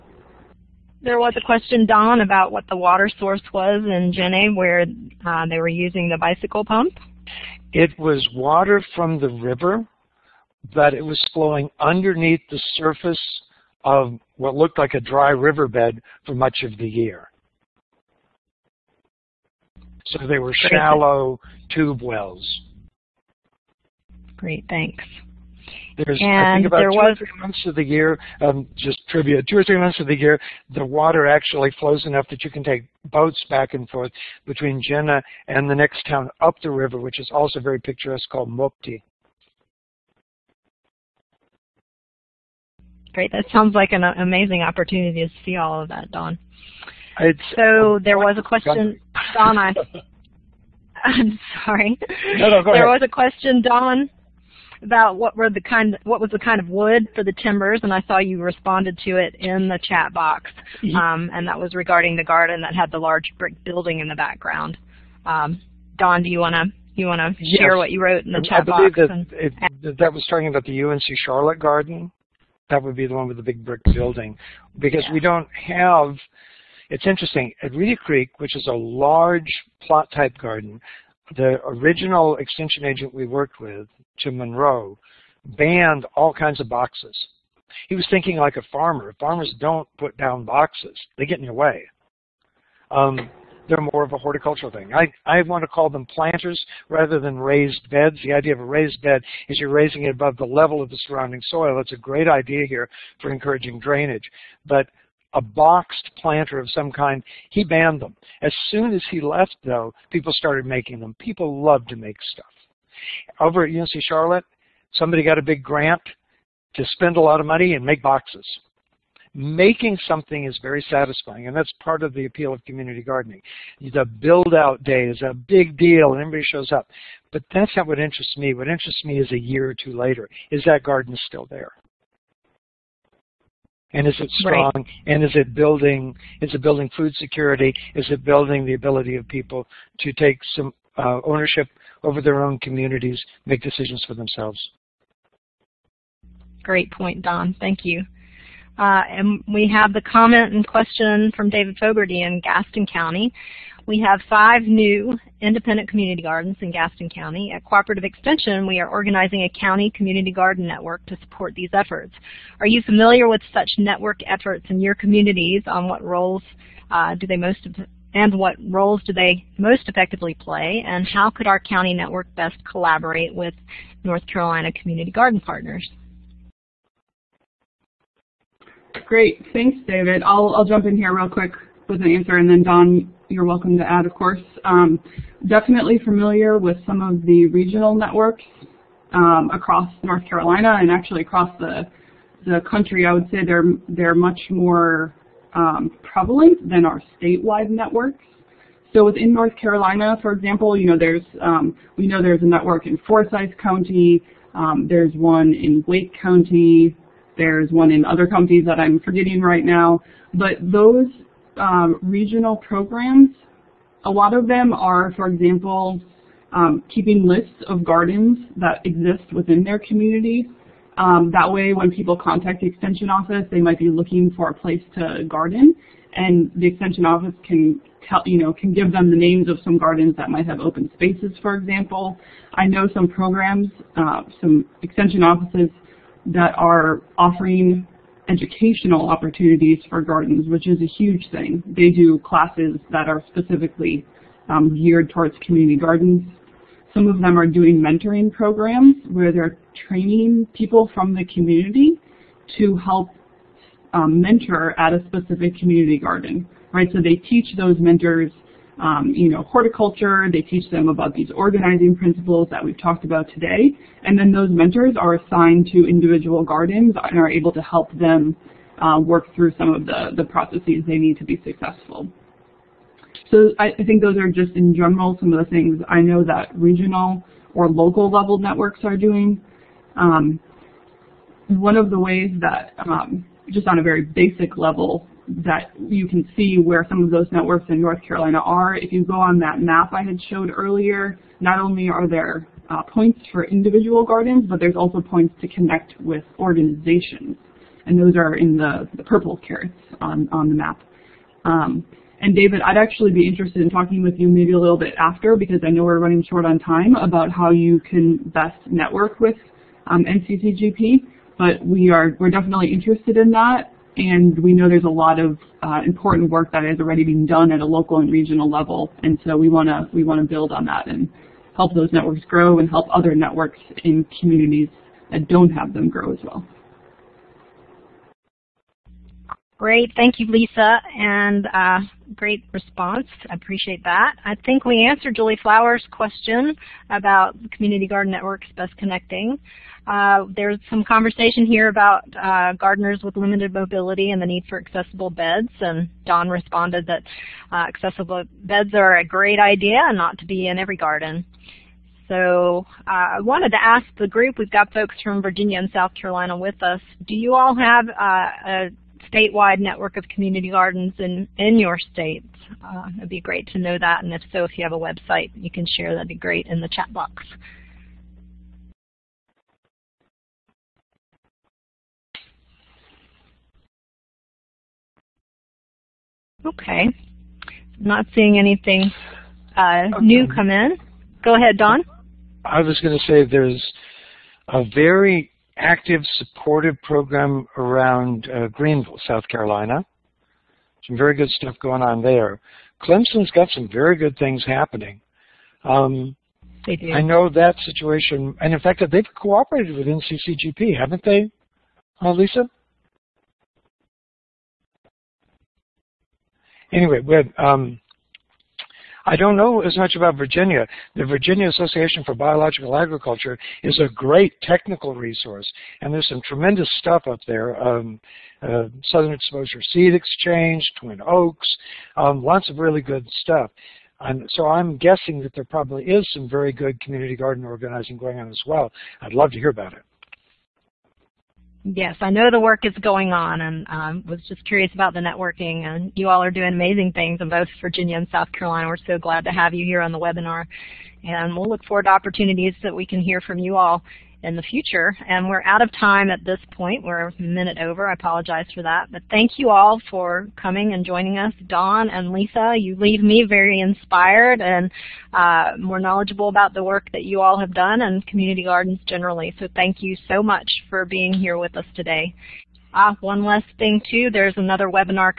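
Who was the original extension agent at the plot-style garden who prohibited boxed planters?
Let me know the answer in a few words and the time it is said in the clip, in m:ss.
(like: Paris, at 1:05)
Jim Monroe, at 1:24.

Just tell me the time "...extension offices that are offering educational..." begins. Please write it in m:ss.
3:54.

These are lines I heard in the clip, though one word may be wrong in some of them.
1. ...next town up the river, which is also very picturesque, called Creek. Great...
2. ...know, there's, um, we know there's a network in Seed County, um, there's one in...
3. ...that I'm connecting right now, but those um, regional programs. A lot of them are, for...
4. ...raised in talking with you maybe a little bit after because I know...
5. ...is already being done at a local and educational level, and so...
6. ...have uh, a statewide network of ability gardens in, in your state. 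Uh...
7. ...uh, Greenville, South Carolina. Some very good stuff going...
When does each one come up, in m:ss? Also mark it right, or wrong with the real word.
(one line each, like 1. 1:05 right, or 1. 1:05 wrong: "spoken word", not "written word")
1. 0:35 wrong: "Mopti", not "Creek"
2. 3:20 wrong: "Forsyth", not "Seed"
3. 3:28 wrong: "forgetting", not "connecting"
4. 5:03 wrong: "interested", not "raised"
5. 5:16 wrong: "regional", not "educational"
6. 5:57 wrong: "community", not "ability"
7. 6:28 right.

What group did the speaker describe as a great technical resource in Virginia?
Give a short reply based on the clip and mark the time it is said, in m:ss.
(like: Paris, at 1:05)
Virginia Association for Biological Agriculture, at 6:51.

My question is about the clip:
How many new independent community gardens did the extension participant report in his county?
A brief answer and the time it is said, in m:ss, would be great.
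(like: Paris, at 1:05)
5, at 2:34.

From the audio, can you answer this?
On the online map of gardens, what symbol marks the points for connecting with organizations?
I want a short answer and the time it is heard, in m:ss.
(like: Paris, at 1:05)
purple carrots, at 4:59.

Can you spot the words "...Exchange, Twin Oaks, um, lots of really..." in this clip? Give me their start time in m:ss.
6:59.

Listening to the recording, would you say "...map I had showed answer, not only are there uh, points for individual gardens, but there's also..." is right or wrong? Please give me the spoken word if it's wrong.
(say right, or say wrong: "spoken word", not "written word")
wrong: "earlier", not "answer".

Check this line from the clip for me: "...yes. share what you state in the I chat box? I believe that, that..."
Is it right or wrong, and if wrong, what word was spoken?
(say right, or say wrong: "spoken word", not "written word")
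wrong: "wrote", not "state".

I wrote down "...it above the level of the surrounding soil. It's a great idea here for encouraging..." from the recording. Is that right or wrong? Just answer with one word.
right.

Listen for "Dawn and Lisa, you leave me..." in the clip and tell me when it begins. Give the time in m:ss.
7:31.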